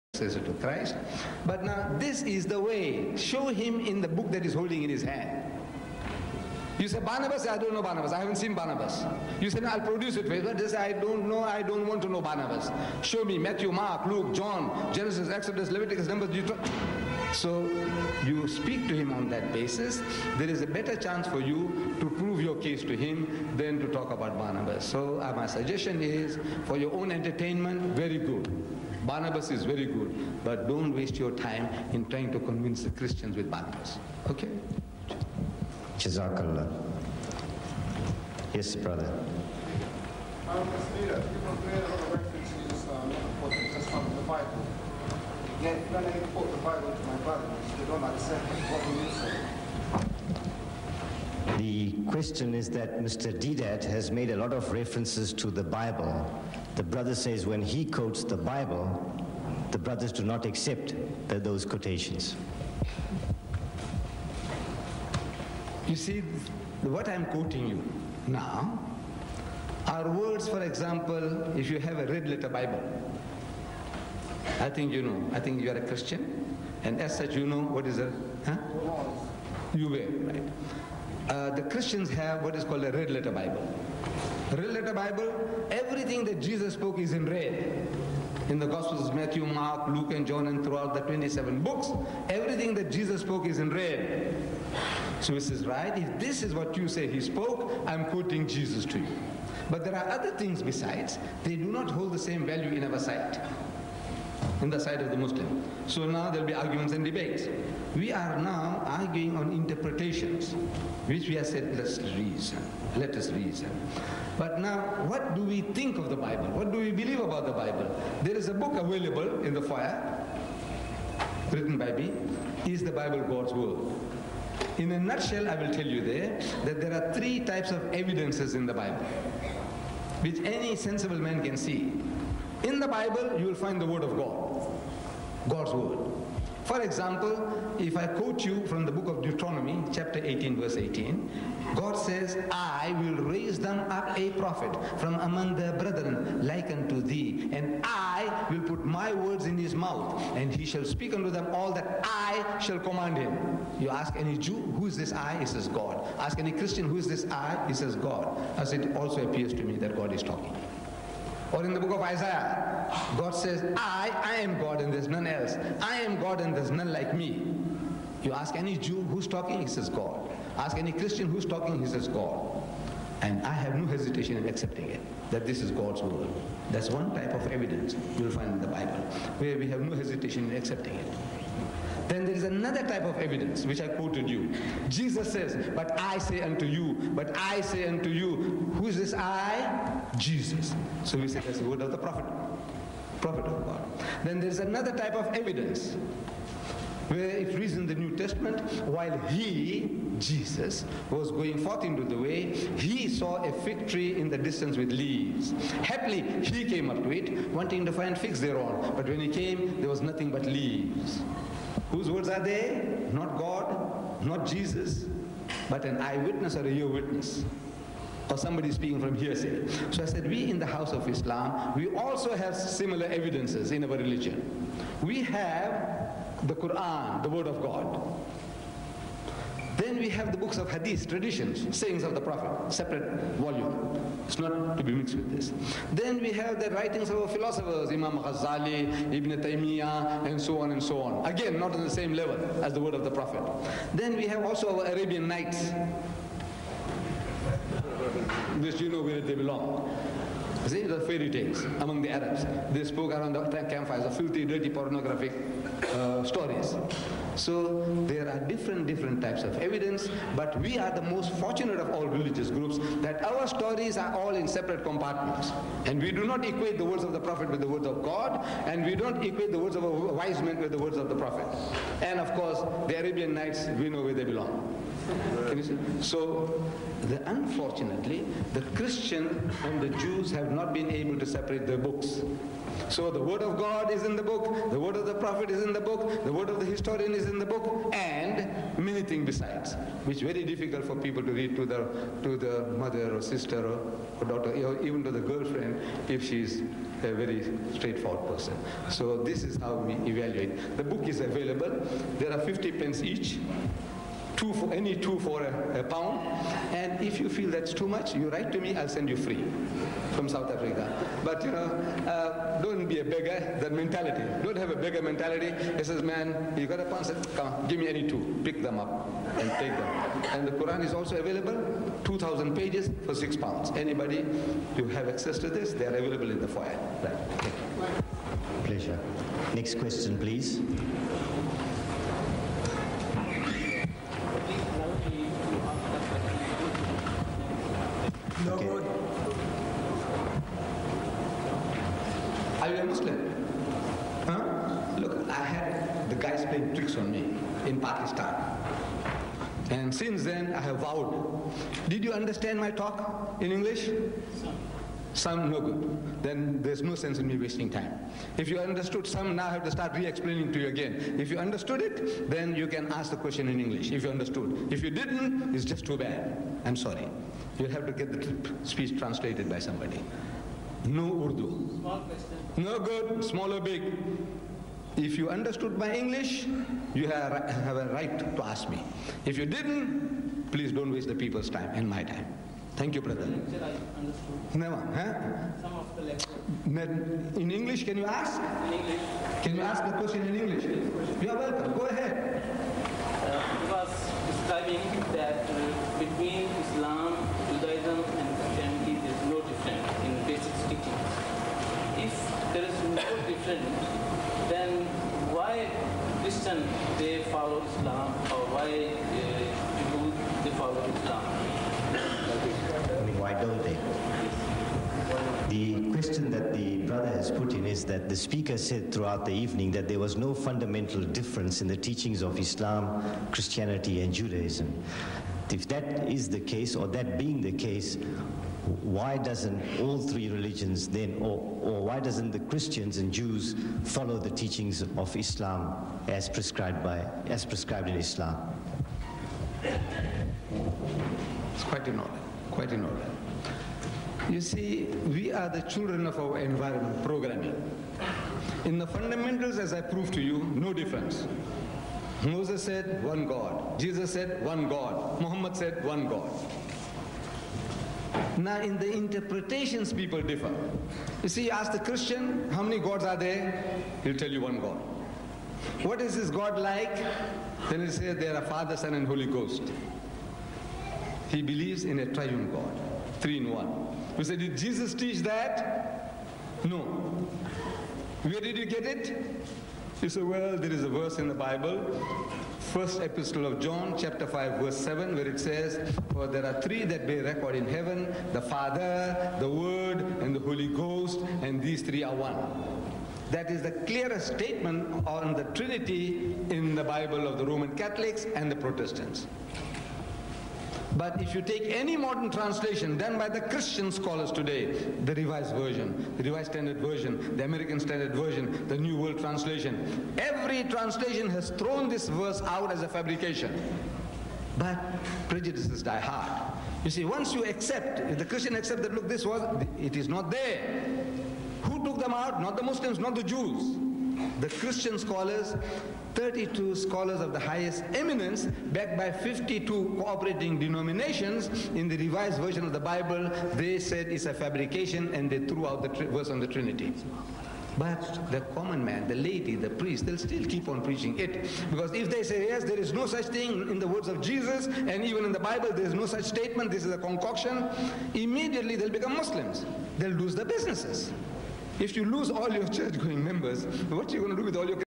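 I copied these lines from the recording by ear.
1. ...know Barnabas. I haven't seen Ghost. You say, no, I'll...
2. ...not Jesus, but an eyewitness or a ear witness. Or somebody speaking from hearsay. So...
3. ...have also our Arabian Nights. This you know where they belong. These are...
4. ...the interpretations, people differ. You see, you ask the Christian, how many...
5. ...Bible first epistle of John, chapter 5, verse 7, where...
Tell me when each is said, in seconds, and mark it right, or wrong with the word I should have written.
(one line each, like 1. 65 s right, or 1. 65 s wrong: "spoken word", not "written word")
1. 7 s wrong: "Barnabas", not "Ghost"
2. 214 s right
3. 244 s right
4. 458 s right
5. 481 s right.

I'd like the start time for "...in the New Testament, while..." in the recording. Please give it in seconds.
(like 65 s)
197 s.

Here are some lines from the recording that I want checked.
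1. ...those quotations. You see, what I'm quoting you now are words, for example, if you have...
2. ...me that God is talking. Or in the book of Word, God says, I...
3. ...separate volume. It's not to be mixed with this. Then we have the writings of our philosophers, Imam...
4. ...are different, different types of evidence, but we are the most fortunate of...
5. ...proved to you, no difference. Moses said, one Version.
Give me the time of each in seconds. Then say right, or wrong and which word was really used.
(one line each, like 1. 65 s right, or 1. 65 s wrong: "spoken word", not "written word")
1. 61 s right
2. 159 s wrong: "Isaiah", not "Word"
3. 232 s right
4. 258 s right
5. 449 s wrong: "God", not "Version".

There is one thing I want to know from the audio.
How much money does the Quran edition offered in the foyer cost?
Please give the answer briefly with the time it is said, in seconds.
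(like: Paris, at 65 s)
6 pounds, at 323 s.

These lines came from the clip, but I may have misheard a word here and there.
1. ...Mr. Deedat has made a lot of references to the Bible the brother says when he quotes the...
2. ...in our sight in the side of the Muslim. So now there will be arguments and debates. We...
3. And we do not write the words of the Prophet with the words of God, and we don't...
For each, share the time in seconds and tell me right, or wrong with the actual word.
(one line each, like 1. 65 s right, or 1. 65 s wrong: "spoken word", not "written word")
1. 53 s right
2. 102 s right
3. 265 s wrong: "equate", not "write".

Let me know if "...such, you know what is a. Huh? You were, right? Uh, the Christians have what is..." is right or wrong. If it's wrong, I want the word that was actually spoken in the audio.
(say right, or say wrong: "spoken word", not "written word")
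right.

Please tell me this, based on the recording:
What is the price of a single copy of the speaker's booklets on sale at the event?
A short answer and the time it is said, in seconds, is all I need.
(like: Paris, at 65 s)
50 pence, at 302 s.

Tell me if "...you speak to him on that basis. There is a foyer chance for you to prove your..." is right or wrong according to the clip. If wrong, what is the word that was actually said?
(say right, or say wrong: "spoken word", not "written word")
wrong: "better", not "foyer".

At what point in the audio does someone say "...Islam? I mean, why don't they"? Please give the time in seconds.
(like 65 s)
410 s.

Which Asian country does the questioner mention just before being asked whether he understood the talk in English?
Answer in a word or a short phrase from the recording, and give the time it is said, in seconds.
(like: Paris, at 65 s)
Pakistan, at 347 s.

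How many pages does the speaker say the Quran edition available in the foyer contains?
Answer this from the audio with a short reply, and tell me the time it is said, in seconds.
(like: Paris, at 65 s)
2,000, at 322 s.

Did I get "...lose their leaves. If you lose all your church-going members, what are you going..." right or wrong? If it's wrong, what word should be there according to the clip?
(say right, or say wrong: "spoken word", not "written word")
wrong: "businesses", not "leaves".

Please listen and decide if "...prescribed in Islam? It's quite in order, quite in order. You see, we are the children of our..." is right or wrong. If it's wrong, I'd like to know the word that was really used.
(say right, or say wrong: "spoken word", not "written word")
right.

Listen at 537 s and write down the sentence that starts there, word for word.
But the common man, the lady, the priest, they'll still keep on preaching it.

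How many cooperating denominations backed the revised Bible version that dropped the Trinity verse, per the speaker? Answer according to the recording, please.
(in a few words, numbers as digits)
52.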